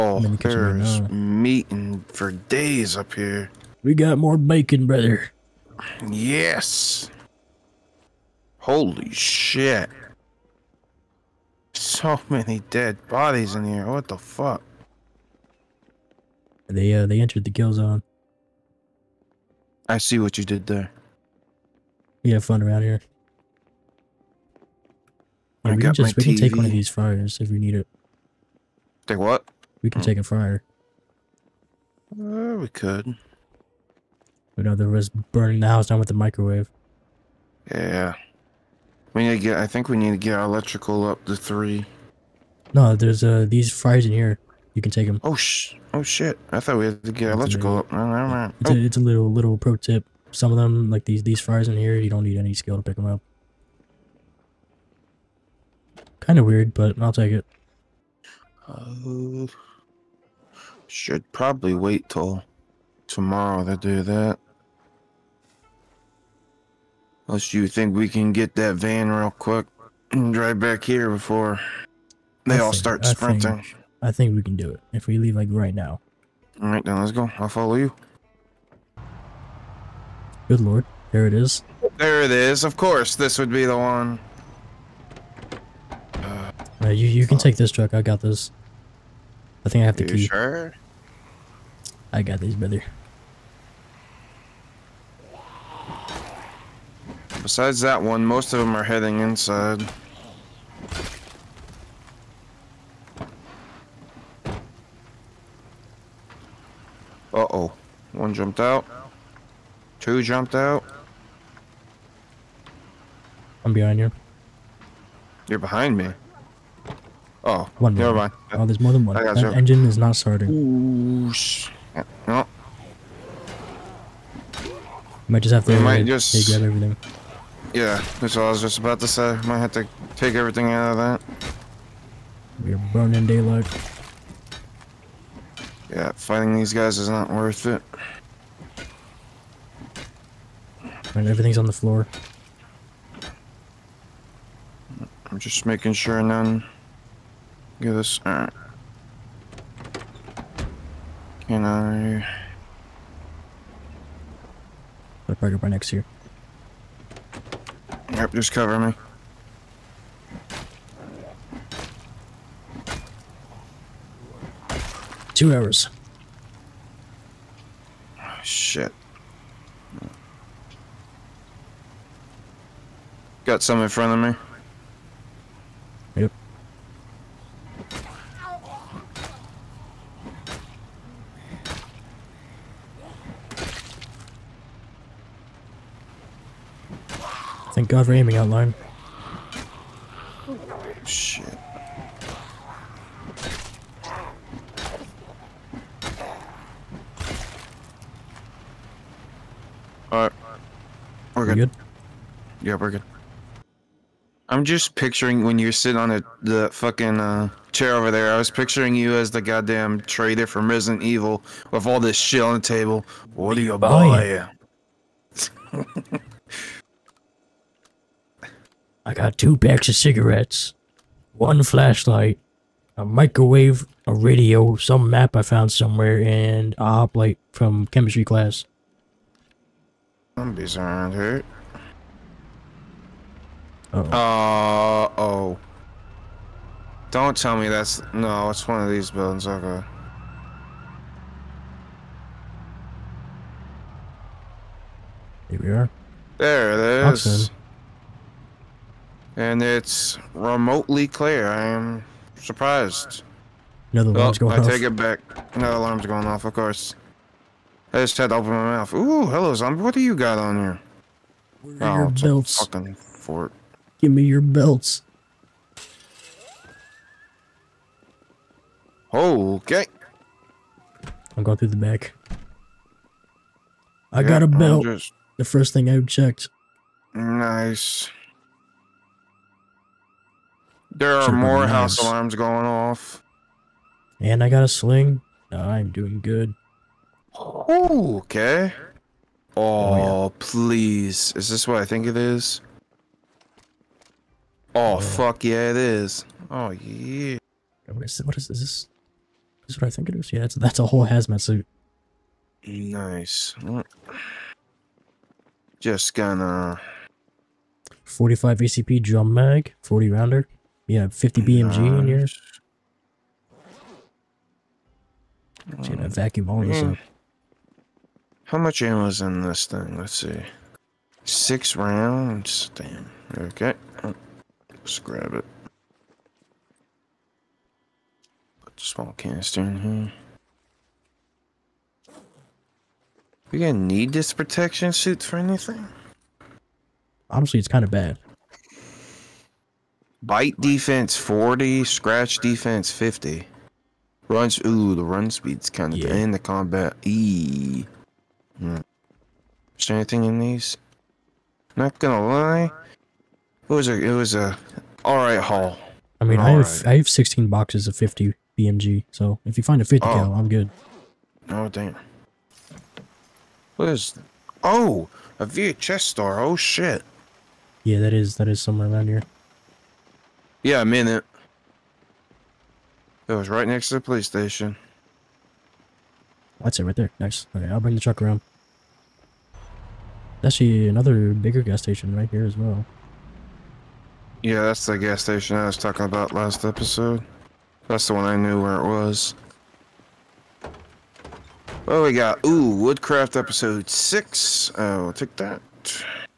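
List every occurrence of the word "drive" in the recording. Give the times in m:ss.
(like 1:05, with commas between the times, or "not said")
1:10.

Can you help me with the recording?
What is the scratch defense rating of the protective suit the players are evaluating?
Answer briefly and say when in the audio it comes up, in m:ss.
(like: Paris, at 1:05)
50, at 5:41.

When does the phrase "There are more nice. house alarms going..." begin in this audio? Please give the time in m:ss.
4:40.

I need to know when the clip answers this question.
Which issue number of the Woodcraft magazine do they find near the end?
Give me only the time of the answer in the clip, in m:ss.
6:33.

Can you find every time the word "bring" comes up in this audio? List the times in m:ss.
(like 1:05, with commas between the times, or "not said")
6:17.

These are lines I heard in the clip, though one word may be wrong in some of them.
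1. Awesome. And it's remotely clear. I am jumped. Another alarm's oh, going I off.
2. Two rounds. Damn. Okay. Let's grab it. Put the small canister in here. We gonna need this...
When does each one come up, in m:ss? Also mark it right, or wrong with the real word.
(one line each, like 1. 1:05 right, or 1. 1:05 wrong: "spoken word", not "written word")
1. 4:07 wrong: "surprised", not "jumped"
2. 5:21 wrong: "Six", not "Two".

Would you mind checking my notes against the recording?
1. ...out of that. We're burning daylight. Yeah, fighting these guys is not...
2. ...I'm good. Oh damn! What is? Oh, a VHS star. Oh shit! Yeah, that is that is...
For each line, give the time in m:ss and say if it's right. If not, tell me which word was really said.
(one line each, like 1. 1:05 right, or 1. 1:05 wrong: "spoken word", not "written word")
1. 2:10 right
2. 6:00 right.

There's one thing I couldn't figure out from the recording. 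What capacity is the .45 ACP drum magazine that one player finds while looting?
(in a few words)
40 rounds.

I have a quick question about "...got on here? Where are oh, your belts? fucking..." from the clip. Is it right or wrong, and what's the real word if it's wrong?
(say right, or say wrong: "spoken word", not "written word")
right.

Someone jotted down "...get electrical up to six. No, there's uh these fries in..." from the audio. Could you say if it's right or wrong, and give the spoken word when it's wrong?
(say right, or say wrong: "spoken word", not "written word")
wrong: "three", not "six".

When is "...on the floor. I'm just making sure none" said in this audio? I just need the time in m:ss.
2:21.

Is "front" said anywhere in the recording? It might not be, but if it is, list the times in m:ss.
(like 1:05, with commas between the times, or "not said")
2:53.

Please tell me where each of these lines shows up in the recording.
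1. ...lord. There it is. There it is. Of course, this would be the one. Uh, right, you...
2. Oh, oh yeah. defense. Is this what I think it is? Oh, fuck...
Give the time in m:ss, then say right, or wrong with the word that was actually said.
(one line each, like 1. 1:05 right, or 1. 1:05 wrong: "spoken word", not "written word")
1. 1:20 right
2. 4:49 wrong: "please", not "defense".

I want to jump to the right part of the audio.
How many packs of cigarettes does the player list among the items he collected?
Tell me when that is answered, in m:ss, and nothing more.
3:39.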